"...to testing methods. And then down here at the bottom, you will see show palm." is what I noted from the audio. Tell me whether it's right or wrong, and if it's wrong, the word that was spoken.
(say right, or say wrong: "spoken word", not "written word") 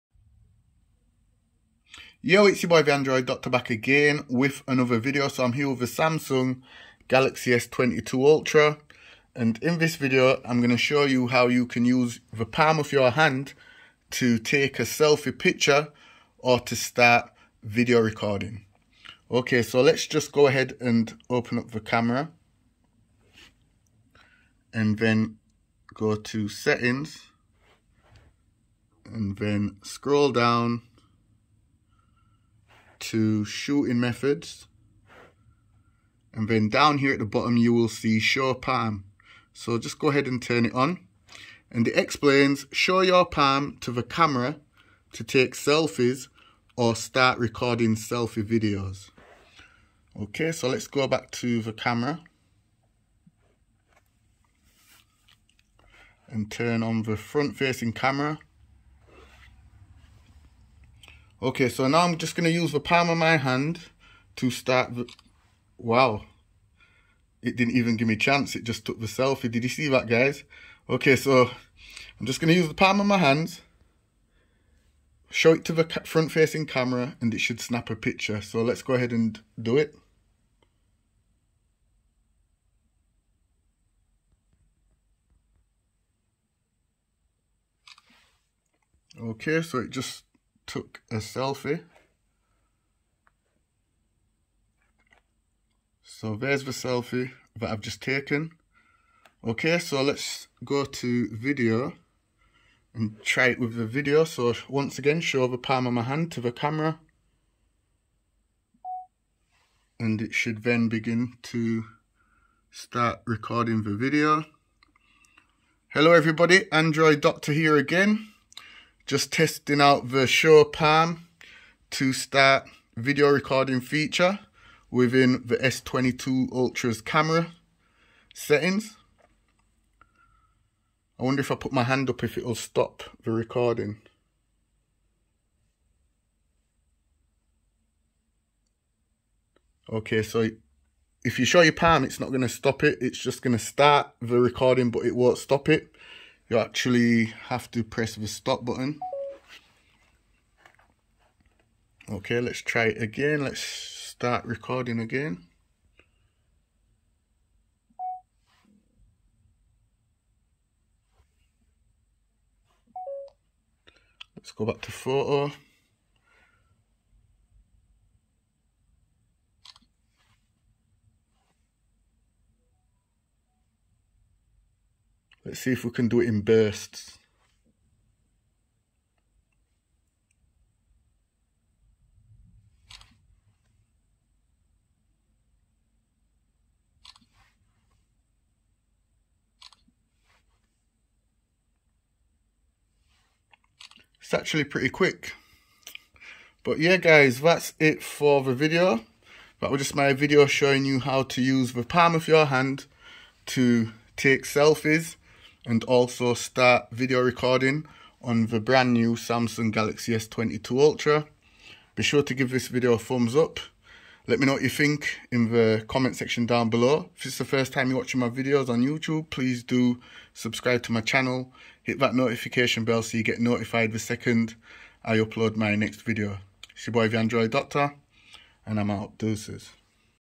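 wrong: "shooting", not "testing".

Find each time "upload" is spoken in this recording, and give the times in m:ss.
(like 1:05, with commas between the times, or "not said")
3:45.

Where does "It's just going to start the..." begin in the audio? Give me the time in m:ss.
2:23.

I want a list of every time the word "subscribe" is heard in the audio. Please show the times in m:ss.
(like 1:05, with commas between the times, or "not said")
3:40.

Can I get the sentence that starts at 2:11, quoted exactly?
I wonder if I put my hand up if it'll stop the recording.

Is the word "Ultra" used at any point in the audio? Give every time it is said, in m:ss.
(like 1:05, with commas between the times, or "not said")
0:08, 2:06, 3:30.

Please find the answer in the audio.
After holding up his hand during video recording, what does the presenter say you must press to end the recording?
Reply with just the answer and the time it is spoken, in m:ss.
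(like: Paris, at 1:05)
The stop button, at 2:28.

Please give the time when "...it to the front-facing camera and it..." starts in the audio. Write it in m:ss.
1:15.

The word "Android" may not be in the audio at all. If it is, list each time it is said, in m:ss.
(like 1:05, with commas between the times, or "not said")
0:02, 1:56, 3:47.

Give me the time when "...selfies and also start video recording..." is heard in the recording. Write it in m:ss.
3:24.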